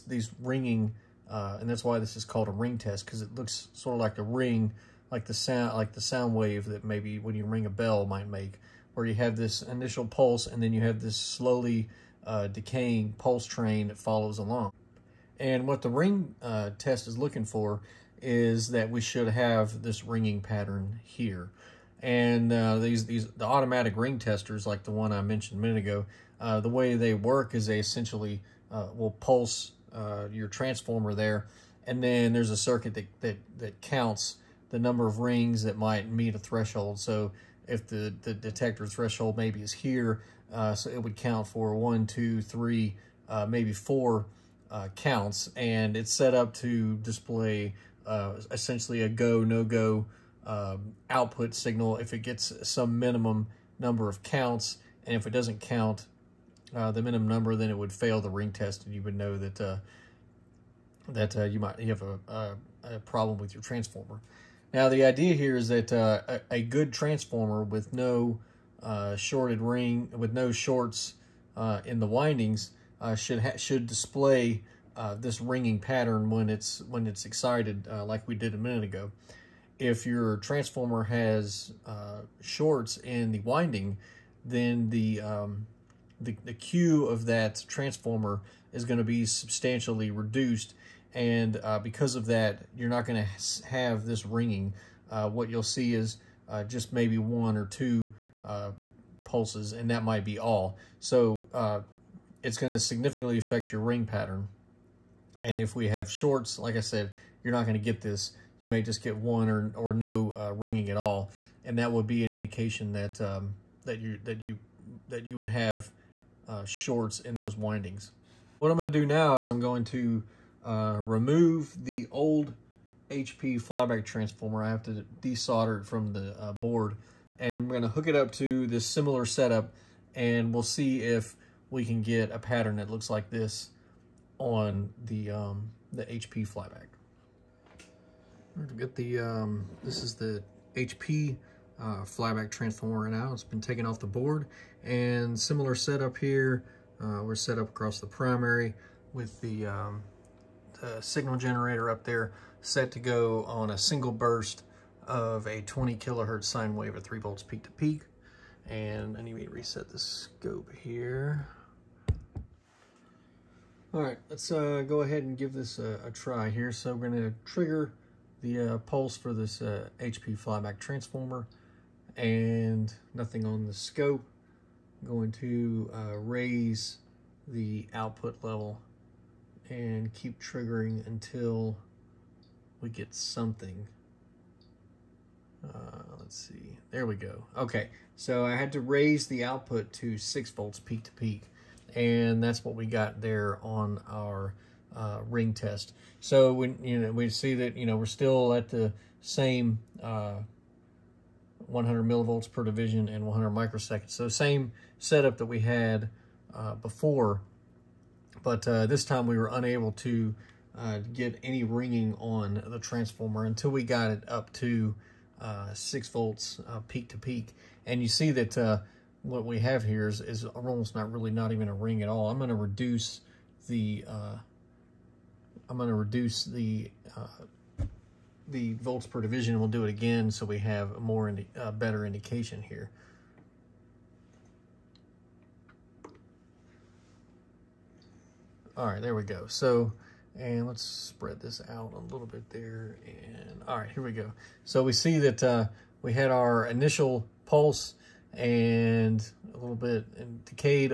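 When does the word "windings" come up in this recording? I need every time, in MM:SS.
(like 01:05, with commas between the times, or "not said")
01:12, 01:23, 01:57.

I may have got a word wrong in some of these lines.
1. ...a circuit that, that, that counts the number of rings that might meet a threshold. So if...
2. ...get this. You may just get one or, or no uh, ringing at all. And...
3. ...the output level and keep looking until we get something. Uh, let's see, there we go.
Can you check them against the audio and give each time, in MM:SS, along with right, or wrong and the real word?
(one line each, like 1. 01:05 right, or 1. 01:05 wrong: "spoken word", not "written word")
1. 00:32 right
2. 01:47 right
3. 02:57 wrong: "triggering", not "looking".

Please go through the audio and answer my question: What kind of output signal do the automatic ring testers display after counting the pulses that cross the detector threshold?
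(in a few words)
go, no-go.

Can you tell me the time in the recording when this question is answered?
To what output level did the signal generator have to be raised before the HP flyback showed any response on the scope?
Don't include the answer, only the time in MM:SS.
03:10.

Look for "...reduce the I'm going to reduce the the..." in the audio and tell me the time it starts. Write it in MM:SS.
03:42.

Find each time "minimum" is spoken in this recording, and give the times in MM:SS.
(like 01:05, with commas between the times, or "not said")
00:52, 00:57.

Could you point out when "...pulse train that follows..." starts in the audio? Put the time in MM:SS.
00:13.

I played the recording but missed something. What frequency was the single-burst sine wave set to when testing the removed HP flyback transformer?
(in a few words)
20 kilohertz.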